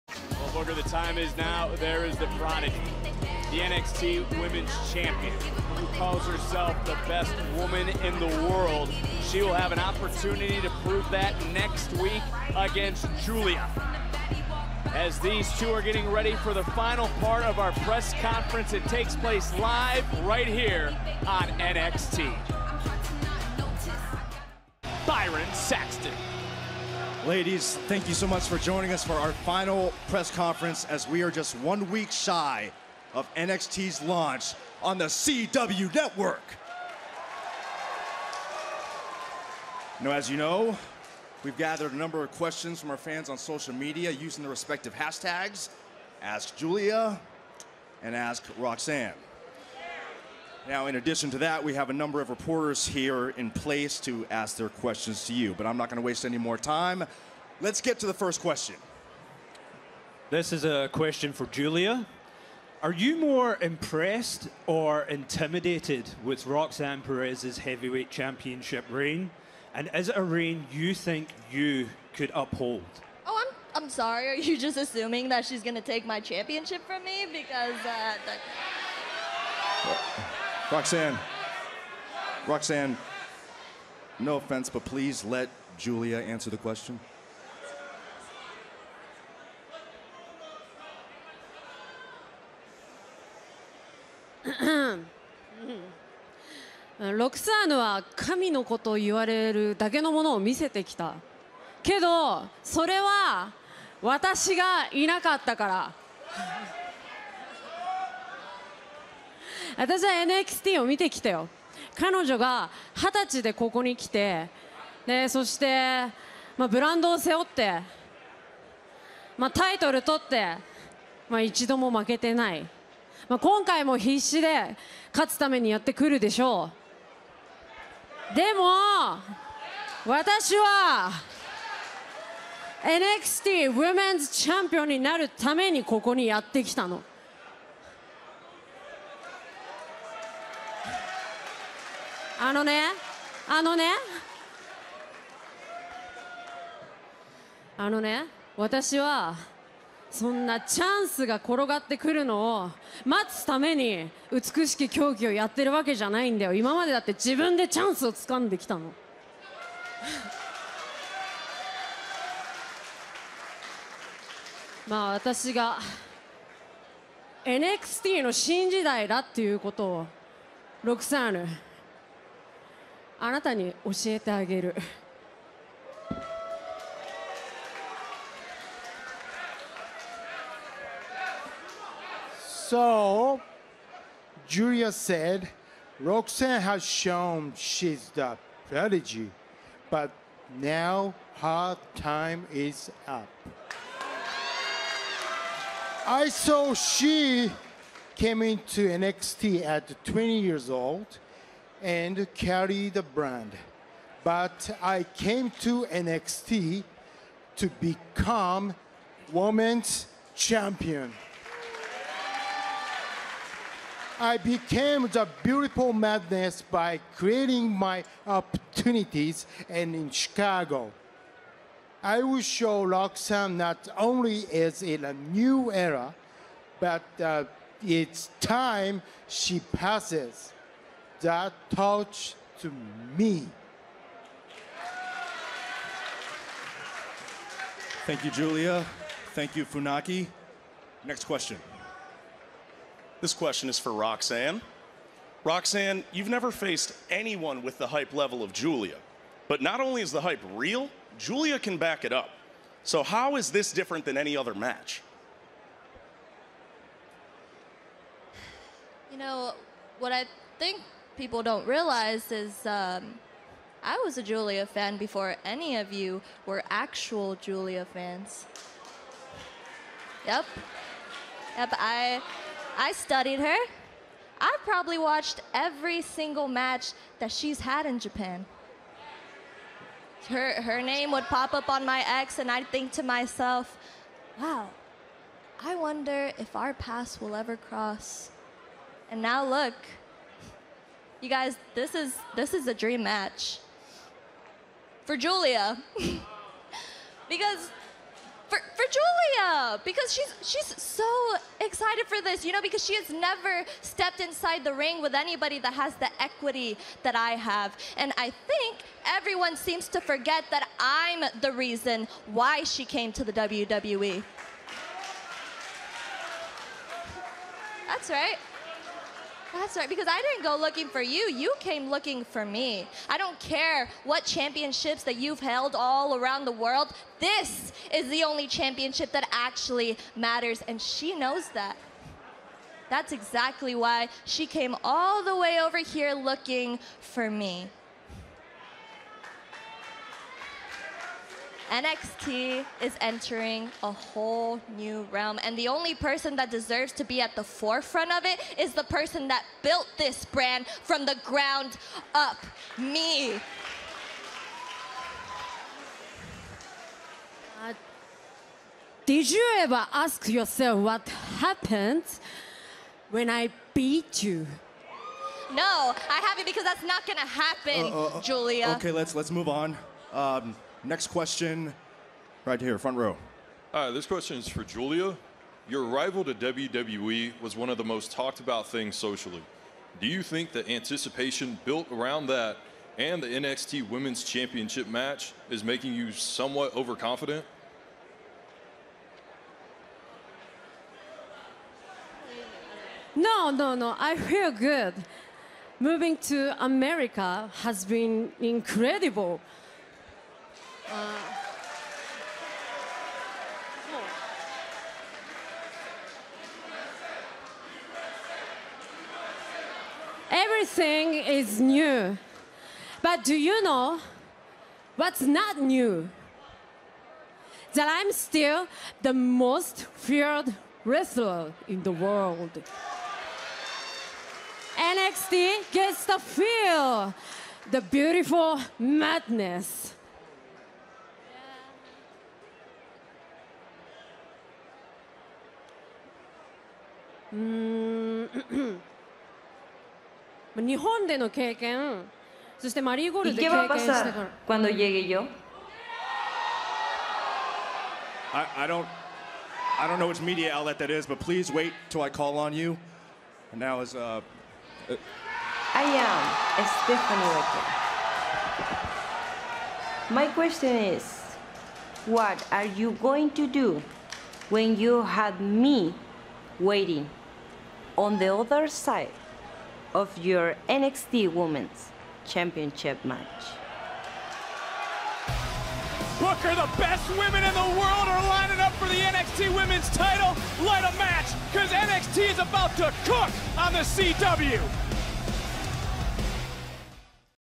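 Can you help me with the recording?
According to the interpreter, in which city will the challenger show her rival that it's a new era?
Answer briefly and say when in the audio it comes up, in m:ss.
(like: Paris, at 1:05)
Chicago, at 3:40.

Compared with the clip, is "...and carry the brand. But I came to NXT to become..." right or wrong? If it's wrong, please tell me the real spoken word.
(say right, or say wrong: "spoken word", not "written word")
right.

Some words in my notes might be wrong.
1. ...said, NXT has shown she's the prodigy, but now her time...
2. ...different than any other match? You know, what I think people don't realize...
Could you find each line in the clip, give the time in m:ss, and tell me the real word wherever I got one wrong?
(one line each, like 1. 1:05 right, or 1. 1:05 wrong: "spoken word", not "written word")
1. 3:04 wrong: "Roxanne", not "NXT"
2. 4:13 right.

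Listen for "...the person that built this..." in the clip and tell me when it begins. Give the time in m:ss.
5:48.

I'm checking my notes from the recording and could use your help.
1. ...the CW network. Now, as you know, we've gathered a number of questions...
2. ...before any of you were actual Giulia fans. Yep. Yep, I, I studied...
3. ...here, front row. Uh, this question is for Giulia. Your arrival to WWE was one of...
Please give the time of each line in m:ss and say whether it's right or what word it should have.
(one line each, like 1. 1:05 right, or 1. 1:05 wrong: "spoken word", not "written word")
1. 0:34 right
2. 4:24 right
3. 6:12 right.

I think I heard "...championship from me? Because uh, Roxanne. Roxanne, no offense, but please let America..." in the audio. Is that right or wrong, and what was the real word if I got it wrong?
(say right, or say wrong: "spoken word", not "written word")
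wrong: "Julia", not "America".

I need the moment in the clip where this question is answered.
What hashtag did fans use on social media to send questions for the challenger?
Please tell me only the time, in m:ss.
0:46.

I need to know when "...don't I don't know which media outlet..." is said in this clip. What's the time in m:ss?
7:28.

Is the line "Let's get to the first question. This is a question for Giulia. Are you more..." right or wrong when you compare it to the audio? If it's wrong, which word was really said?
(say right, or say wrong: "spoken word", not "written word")
right.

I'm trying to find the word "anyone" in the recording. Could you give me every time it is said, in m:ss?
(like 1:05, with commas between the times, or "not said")
4:07.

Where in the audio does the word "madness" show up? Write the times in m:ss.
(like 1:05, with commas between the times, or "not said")
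3:35, 7:08.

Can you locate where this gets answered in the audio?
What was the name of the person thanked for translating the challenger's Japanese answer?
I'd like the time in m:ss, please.
3:59.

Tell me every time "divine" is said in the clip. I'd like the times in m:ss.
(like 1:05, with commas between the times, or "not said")
not said.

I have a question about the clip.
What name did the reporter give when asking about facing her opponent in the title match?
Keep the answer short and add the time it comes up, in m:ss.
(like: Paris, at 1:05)
Stephanie Wecker, at 7:36.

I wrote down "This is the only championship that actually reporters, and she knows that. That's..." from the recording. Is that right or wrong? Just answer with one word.
wrong.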